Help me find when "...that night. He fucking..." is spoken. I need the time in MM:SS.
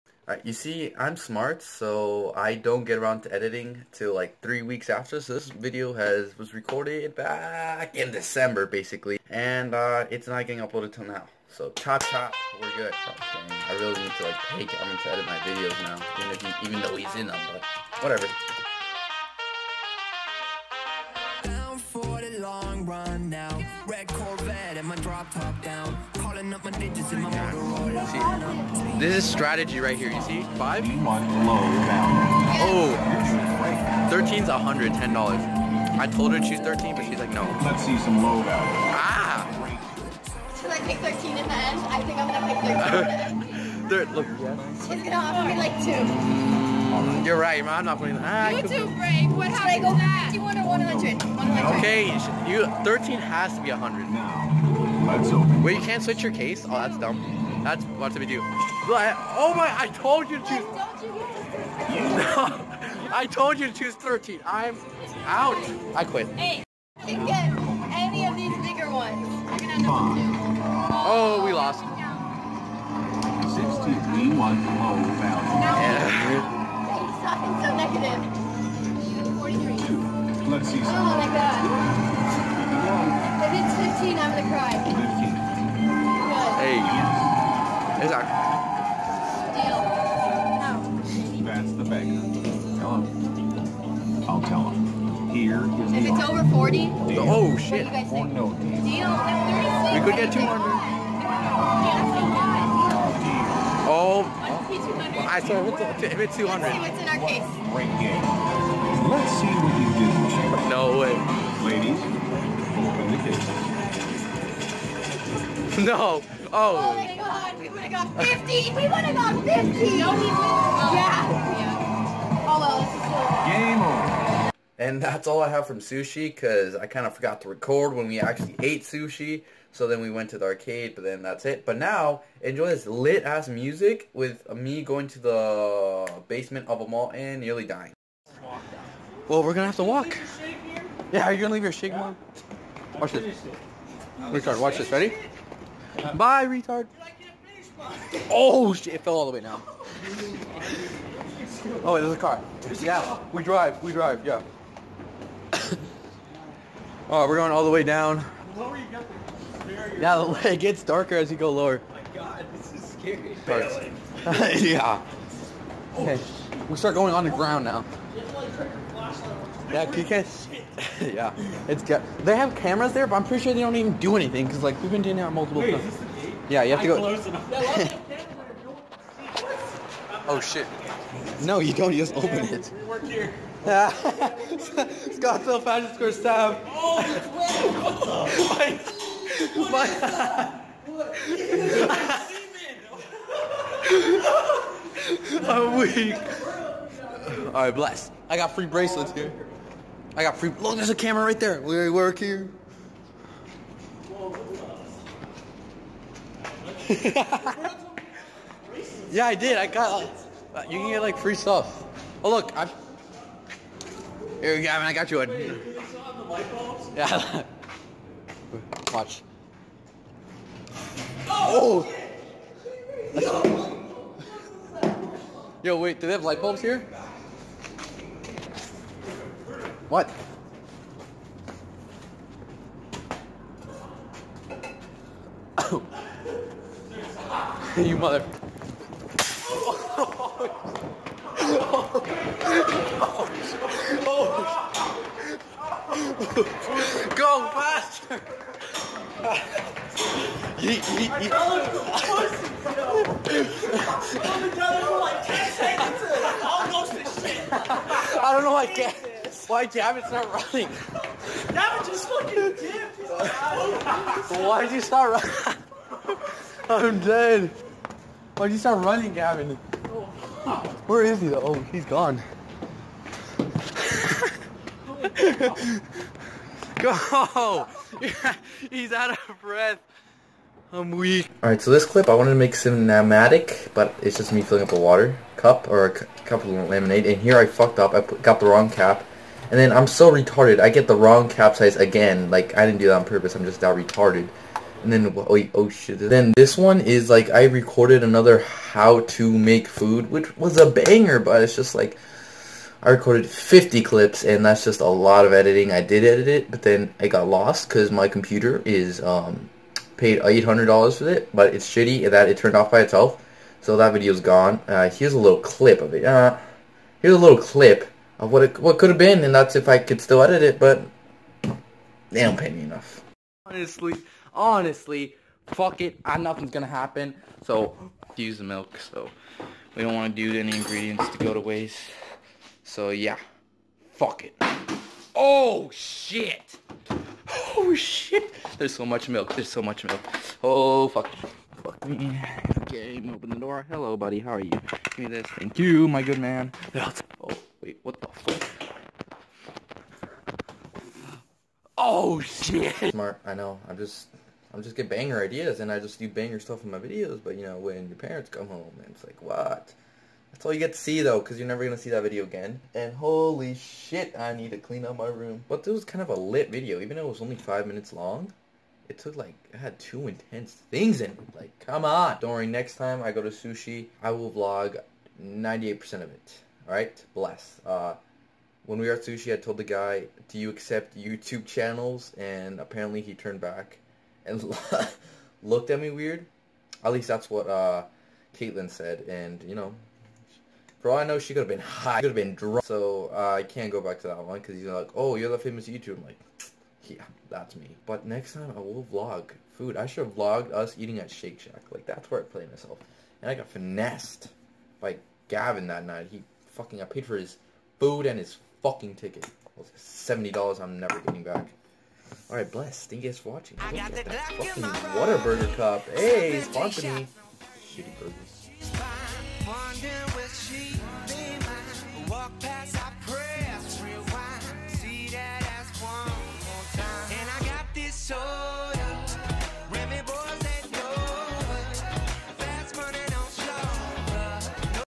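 06:45.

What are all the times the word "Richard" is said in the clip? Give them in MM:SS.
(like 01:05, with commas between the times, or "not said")
02:24.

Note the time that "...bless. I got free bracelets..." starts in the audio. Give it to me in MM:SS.
03:17.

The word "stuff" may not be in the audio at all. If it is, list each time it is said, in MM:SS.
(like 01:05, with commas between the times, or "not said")
03:31, 05:56.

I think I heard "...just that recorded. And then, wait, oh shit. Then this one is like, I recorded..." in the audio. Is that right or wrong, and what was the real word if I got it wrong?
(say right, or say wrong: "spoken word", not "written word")
wrong: "retarded", not "recorded".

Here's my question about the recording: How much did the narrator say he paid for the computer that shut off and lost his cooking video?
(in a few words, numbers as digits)
$800.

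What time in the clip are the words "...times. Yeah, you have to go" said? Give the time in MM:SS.
02:55.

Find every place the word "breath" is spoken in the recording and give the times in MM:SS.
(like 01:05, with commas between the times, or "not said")
04:39.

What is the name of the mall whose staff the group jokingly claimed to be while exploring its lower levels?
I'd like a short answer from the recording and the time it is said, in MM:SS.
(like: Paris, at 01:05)
Scottsdale Fashion Square, at 03:03.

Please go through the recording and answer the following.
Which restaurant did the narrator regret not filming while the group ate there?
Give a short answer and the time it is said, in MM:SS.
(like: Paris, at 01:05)
Shake Shack, at 06:41.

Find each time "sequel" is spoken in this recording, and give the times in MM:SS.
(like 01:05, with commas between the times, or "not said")
not said.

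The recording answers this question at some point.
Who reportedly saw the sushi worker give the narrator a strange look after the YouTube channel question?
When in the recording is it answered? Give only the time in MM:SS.
06:28.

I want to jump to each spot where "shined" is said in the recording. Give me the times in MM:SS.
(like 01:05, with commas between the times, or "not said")
not said.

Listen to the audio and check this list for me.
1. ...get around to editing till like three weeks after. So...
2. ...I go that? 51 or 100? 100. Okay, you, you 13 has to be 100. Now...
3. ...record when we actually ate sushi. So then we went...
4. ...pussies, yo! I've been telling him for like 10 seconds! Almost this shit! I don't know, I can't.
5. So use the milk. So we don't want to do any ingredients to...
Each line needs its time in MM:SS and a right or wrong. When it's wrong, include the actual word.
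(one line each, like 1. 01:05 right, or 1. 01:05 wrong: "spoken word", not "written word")
1. 00:02 right
2. 00:49 right
3. 02:07 right
4. 04:11 right
5. 05:27 right.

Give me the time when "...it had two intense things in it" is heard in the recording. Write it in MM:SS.
06:09.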